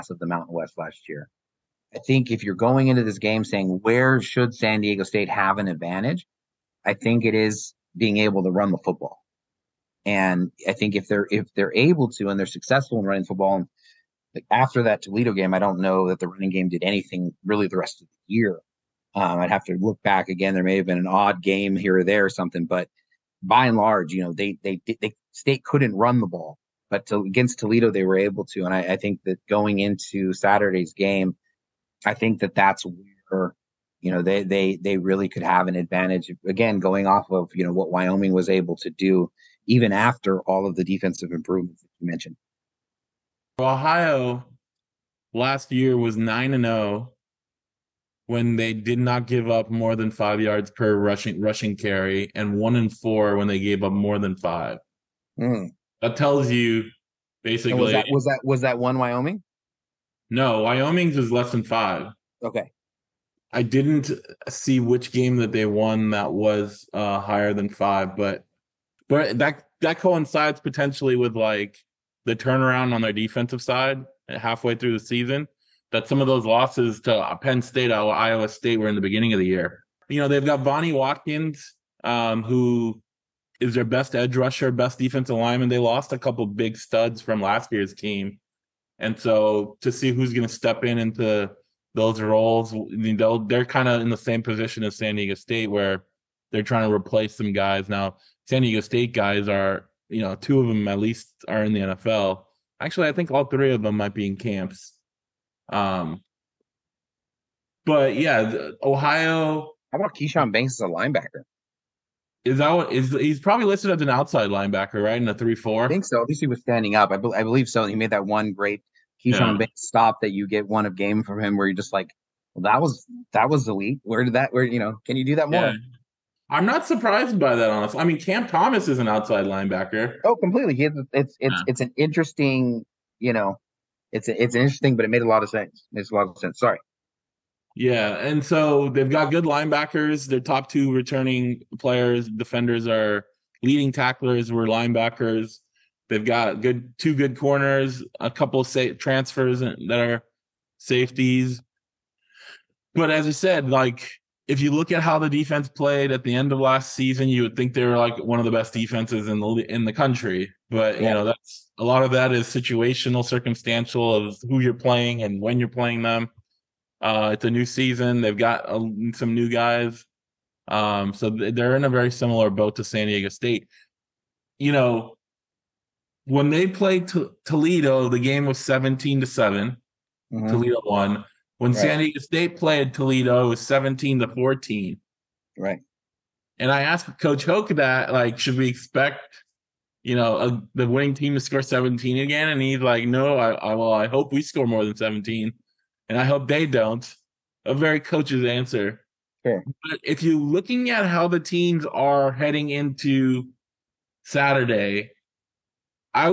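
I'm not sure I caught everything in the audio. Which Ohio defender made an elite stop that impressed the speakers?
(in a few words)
Keshawn Banks.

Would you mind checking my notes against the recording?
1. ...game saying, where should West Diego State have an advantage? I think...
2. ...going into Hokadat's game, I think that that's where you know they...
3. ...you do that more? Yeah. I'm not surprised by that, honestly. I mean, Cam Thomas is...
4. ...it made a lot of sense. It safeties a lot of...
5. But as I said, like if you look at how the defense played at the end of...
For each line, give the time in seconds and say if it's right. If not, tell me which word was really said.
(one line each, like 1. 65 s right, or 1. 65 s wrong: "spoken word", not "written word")
1. 3 s wrong: "San", not "West"
2. 29 s wrong: "Saturday", not "Hokadat"
3. 125 s right
4. 135 s wrong: "makes", not "safeties"
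5. 152 s right.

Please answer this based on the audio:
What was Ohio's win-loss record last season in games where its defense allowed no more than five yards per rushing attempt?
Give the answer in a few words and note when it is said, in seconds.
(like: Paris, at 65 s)
9-0, at 46 s.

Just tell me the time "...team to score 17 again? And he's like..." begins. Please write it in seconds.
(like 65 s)
191 s.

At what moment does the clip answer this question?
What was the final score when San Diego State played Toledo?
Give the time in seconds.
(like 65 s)
183 s.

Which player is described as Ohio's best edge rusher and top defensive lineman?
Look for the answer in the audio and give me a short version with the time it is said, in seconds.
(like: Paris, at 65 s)
Vonnie Watkins, at 80 s.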